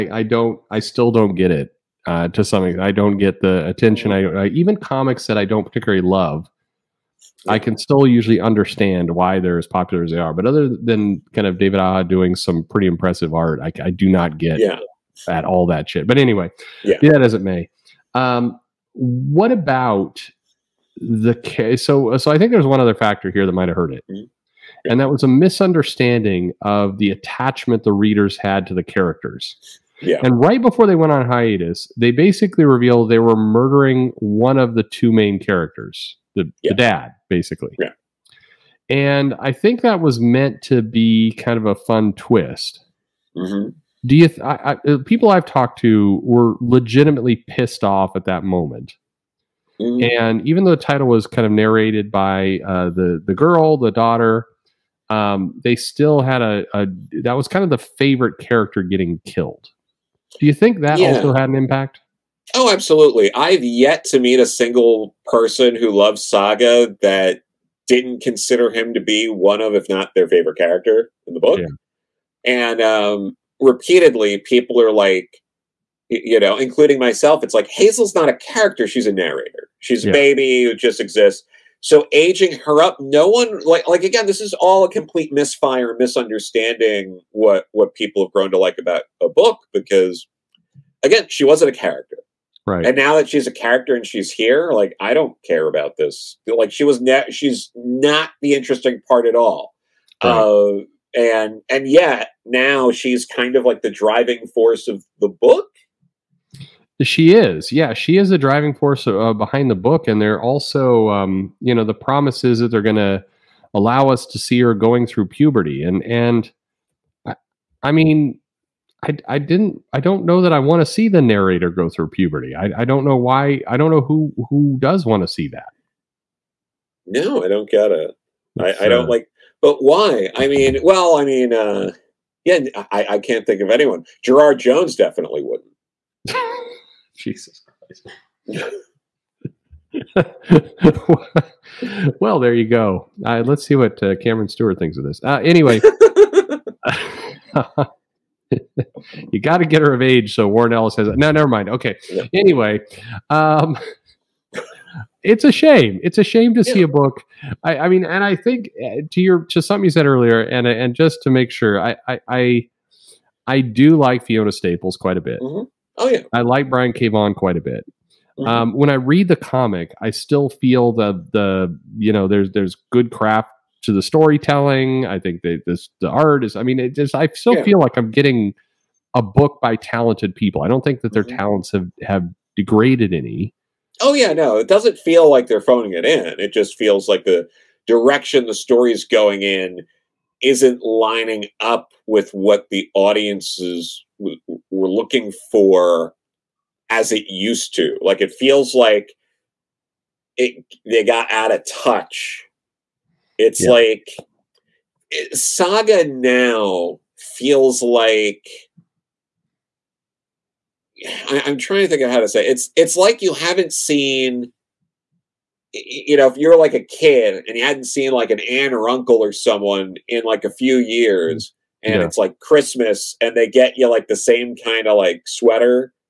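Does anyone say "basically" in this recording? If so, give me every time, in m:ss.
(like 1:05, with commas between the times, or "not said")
0:32, 0:37.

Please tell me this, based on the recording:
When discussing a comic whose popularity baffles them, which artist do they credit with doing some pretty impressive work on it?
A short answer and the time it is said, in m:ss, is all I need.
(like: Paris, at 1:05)
David Aja, at 0:11.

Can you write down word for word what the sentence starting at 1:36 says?
Like she was, ne- she's not the interesting part at all.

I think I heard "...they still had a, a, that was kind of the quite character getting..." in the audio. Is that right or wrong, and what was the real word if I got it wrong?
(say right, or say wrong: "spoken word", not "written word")
wrong: "favorite", not "quite".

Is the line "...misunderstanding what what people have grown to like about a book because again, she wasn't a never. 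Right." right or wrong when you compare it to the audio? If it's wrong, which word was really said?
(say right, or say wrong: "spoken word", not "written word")
wrong: "character", not "never".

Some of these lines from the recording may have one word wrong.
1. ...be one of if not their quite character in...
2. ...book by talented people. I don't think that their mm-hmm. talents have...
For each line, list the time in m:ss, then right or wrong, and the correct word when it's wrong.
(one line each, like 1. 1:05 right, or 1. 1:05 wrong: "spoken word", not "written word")
1. 1:08 wrong: "favorite", not "quite"
2. 2:59 right.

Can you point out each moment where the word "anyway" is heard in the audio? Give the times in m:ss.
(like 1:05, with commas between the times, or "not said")
0:16, 2:25, 2:32.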